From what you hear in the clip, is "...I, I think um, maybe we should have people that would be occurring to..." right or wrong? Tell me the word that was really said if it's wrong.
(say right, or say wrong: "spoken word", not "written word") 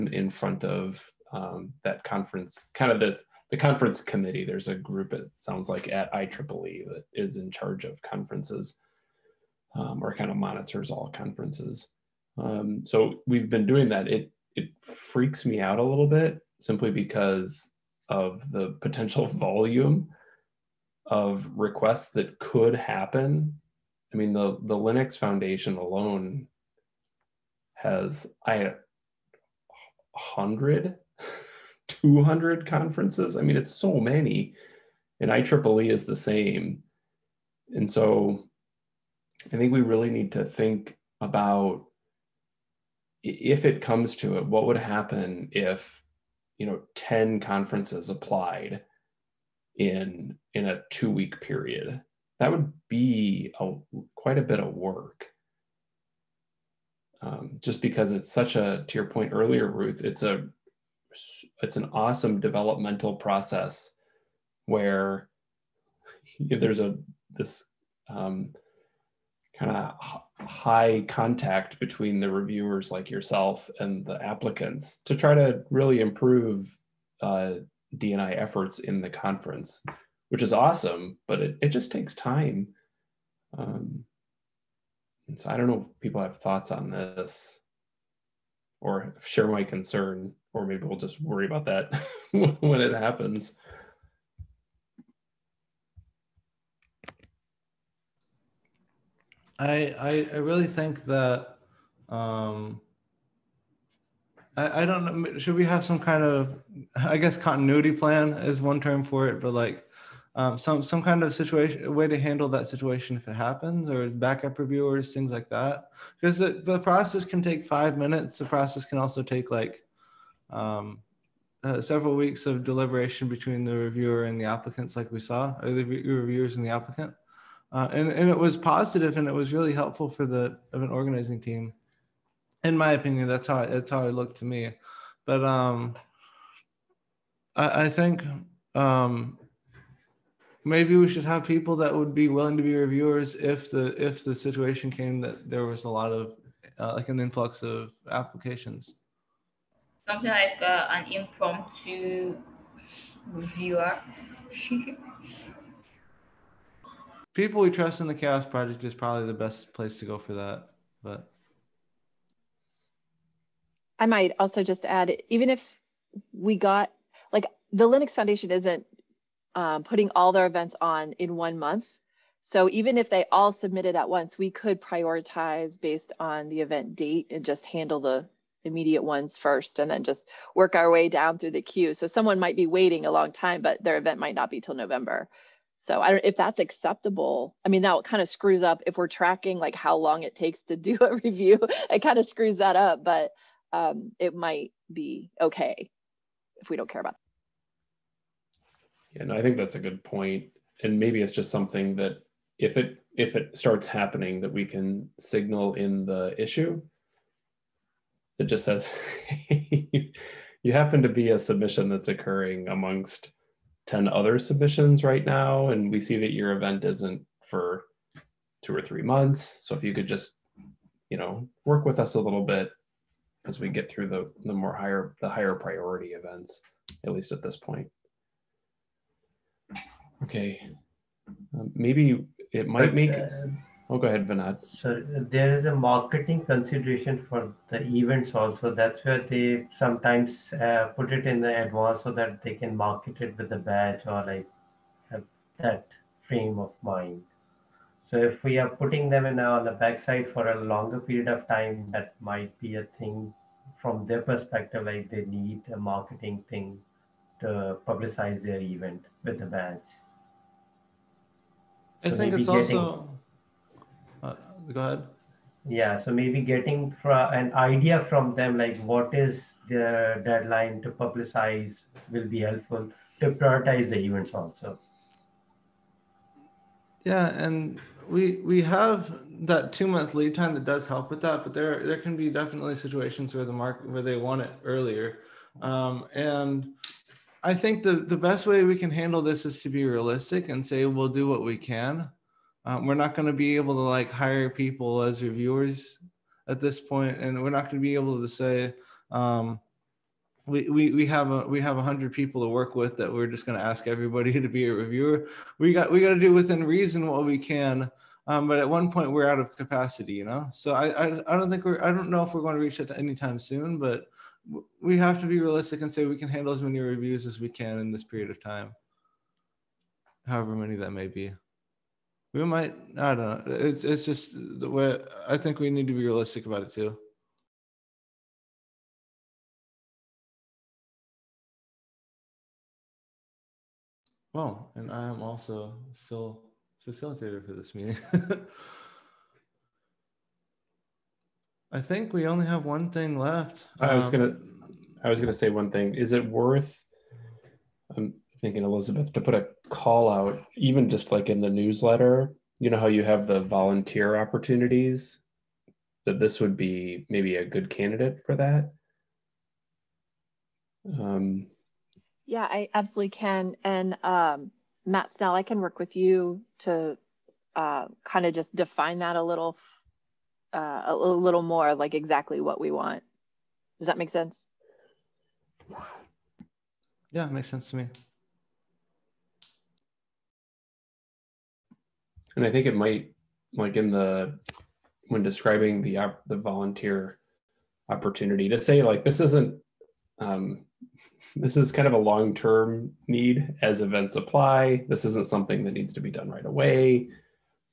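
wrong: "willing", not "occurring".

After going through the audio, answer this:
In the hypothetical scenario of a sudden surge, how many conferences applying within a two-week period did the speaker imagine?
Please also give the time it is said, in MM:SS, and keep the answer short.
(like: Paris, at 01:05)
10, at 00:46.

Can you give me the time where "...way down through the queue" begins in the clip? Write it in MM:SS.
03:00.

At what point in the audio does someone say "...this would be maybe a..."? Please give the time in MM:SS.
05:56.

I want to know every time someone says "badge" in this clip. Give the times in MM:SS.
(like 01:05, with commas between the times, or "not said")
04:03, 04:19.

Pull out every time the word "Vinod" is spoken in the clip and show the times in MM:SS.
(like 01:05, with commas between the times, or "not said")
03:54.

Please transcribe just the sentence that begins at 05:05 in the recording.
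We got we got to do within reason what we can.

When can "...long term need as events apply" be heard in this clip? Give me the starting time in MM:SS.
06:31.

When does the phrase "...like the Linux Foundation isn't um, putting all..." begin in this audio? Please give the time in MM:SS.
02:47.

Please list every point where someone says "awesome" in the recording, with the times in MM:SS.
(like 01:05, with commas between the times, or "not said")
01:01, 01:20.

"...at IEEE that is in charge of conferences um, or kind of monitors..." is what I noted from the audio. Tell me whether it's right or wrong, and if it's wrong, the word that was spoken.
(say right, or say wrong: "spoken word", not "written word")
right.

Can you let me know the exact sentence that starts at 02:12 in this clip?
In my opinion, that's how that's how it looked to me.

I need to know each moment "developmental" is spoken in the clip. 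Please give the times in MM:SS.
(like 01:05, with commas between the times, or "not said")
01:02.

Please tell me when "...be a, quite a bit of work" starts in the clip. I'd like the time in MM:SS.
00:52.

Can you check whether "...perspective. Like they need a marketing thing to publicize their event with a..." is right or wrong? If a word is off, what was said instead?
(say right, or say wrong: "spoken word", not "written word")
right.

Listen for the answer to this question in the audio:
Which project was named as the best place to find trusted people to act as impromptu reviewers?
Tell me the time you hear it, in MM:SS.
02:38.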